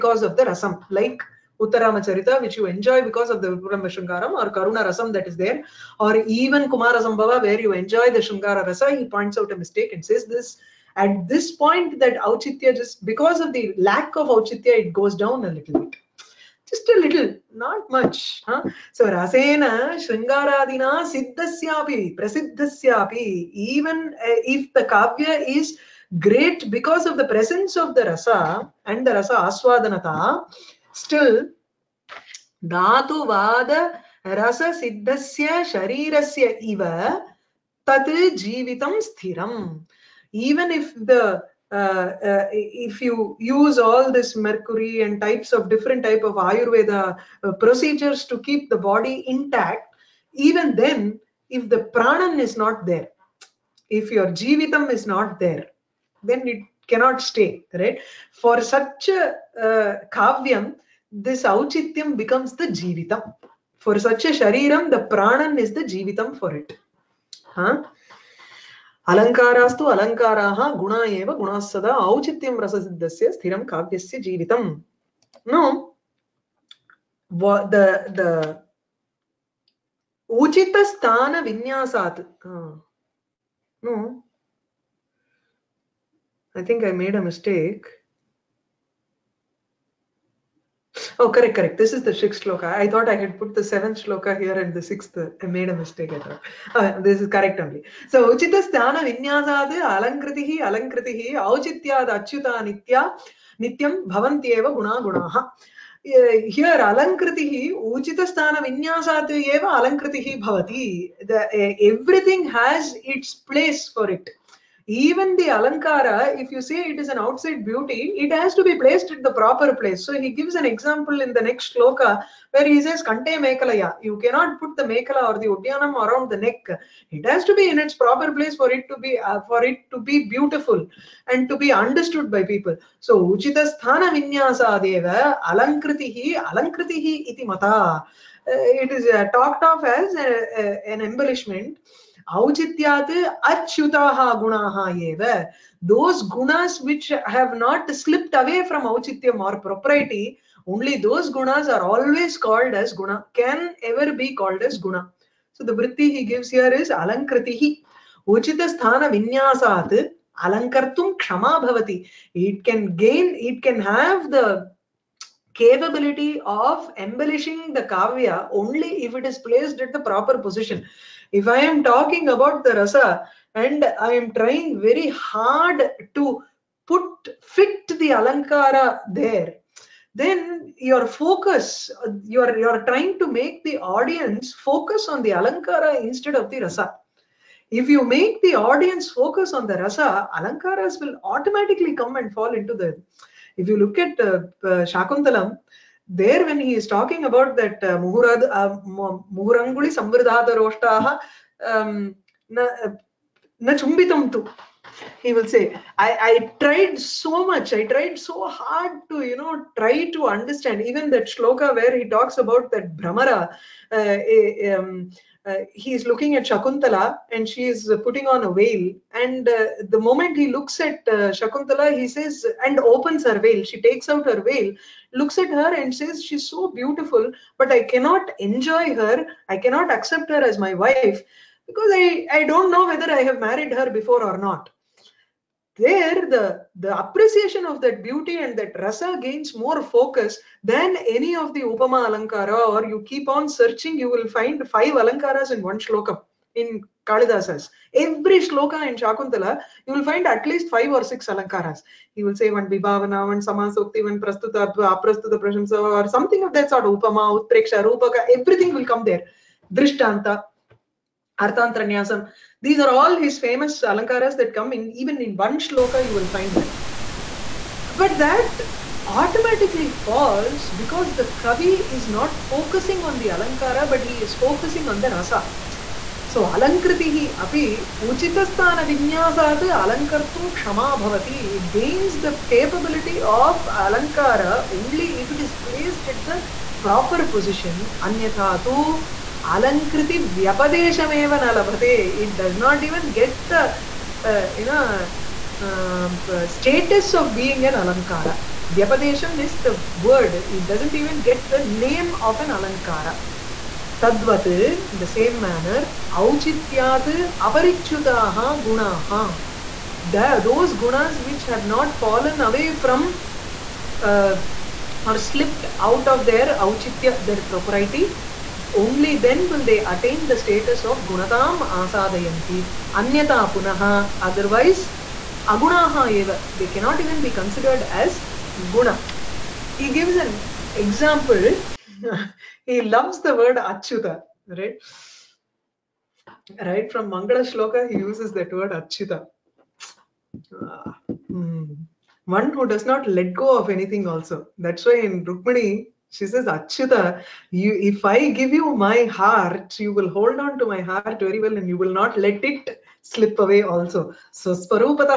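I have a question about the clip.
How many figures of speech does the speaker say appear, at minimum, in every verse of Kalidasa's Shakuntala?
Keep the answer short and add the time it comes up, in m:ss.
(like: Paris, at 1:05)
Five or six, at 4:10.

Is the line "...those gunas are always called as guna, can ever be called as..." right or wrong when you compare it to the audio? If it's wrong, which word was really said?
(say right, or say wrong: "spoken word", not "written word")
right.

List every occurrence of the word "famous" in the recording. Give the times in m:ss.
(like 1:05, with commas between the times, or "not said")
4:23.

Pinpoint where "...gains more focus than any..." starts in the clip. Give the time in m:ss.
3:59.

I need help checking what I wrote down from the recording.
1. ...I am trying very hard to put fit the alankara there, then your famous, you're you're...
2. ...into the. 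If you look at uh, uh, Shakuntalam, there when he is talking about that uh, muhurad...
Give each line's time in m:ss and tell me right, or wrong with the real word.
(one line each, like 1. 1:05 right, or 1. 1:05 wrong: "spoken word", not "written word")
1. 2:53 wrong: "focus", not "famous"
2. 3:12 right.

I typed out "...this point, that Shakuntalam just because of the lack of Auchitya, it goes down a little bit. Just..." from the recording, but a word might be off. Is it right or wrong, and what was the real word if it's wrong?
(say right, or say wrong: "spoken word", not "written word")
wrong: "Auchitya", not "Shakuntalam".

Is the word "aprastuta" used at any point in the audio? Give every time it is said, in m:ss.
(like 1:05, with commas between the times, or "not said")
4:14.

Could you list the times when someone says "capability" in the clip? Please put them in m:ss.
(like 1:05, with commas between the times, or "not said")
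2:45, 4:42.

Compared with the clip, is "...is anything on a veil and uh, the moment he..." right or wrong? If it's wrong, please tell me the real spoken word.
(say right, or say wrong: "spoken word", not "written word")
wrong: "putting", not "anything".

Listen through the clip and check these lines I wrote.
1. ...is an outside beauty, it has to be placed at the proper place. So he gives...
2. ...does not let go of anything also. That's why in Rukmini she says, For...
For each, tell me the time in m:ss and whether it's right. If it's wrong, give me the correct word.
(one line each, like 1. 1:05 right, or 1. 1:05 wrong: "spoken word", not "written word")
1. 1:56 right
2. 5:42 wrong: "Achyuta", not "For".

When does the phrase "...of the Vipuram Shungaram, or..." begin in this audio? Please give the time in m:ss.
0:03.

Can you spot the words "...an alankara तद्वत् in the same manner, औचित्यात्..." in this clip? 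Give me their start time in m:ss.
5:02.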